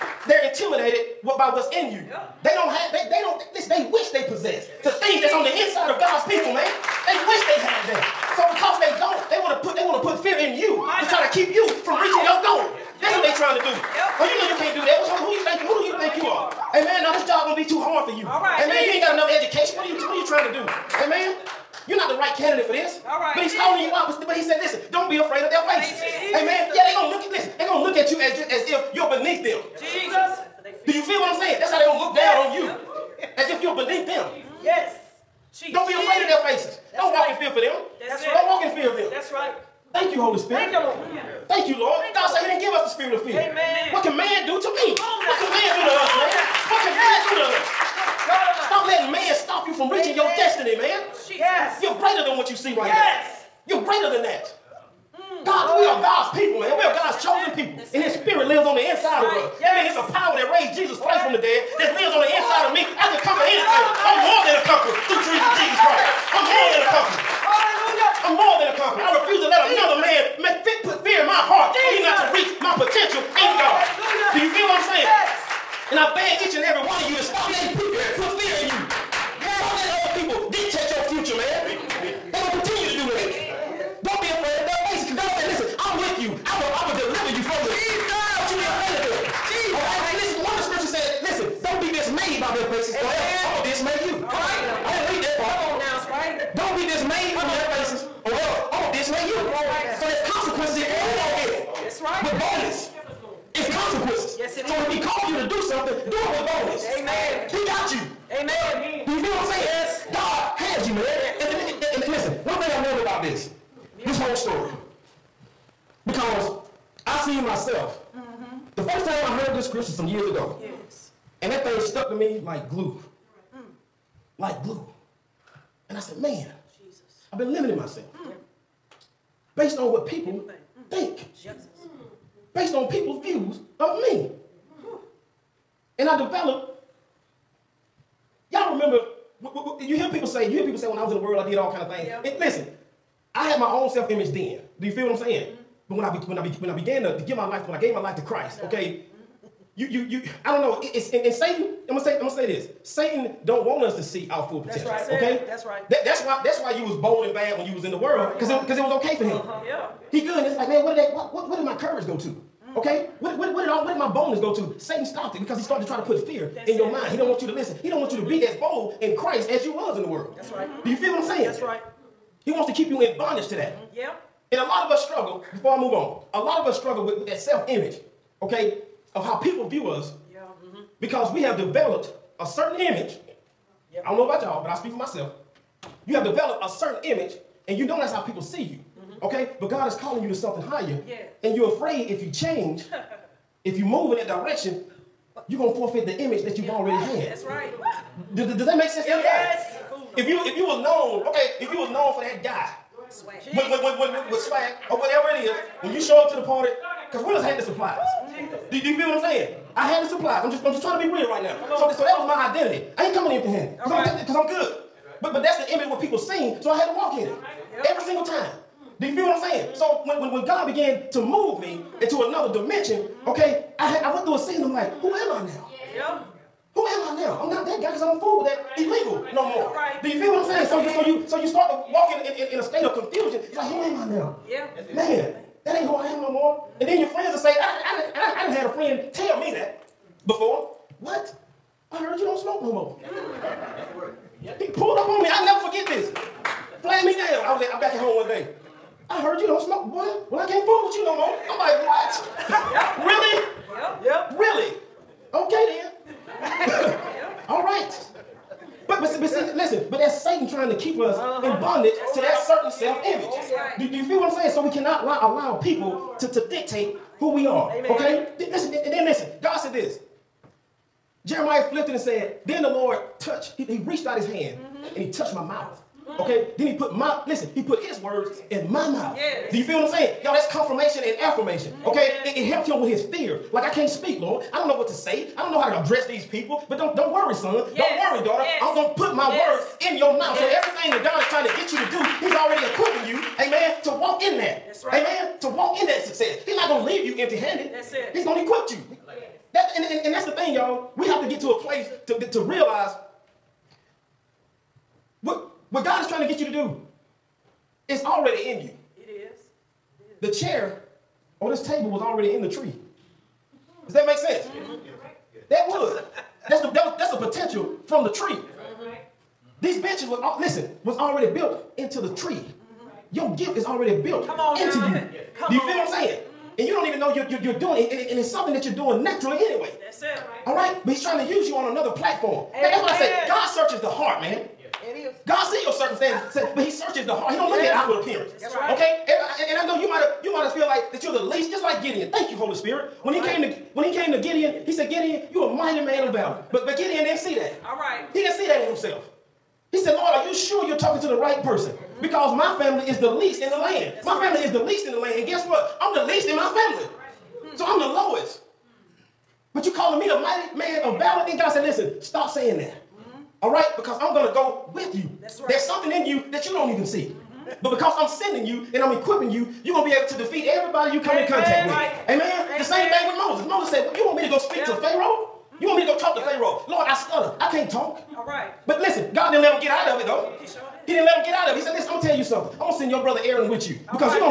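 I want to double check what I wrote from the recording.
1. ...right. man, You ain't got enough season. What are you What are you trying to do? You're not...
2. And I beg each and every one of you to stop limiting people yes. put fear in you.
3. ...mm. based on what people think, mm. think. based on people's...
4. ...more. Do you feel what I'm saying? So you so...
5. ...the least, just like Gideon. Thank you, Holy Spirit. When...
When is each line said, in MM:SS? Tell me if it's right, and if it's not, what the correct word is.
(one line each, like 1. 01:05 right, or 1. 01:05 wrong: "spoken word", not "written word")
1. 00:18 wrong: "education", not "season"
2. 01:15 wrong: "letting", not "limiting"
3. 02:08 right
4. 03:49 right
5. 05:41 right.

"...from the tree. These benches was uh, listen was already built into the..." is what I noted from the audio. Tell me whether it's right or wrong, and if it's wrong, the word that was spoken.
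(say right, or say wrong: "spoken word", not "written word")
right.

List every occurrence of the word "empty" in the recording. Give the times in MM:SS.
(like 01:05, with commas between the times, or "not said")
03:33, 04:57.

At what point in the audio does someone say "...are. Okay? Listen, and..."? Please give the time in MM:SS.
04:27.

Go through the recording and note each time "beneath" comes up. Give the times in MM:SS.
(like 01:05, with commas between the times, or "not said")
00:29, 00:33.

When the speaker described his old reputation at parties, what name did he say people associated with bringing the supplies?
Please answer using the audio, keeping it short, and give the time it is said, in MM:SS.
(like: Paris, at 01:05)
Willis, at 03:27.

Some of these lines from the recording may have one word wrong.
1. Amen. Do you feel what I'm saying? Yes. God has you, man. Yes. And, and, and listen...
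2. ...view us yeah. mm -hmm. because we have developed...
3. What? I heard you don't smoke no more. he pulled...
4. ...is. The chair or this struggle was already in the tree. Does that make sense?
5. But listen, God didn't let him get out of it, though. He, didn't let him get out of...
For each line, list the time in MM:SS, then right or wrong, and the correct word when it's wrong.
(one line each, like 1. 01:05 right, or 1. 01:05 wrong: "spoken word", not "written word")
1. 01:48 right
2. 02:59 right
3. 04:01 right
4. 05:10 wrong: "table", not "struggle"
5. 06:18 right.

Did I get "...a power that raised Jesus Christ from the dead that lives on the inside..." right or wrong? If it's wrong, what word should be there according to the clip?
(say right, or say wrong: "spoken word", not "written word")
right.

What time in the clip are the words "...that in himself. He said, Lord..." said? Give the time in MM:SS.
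05:48.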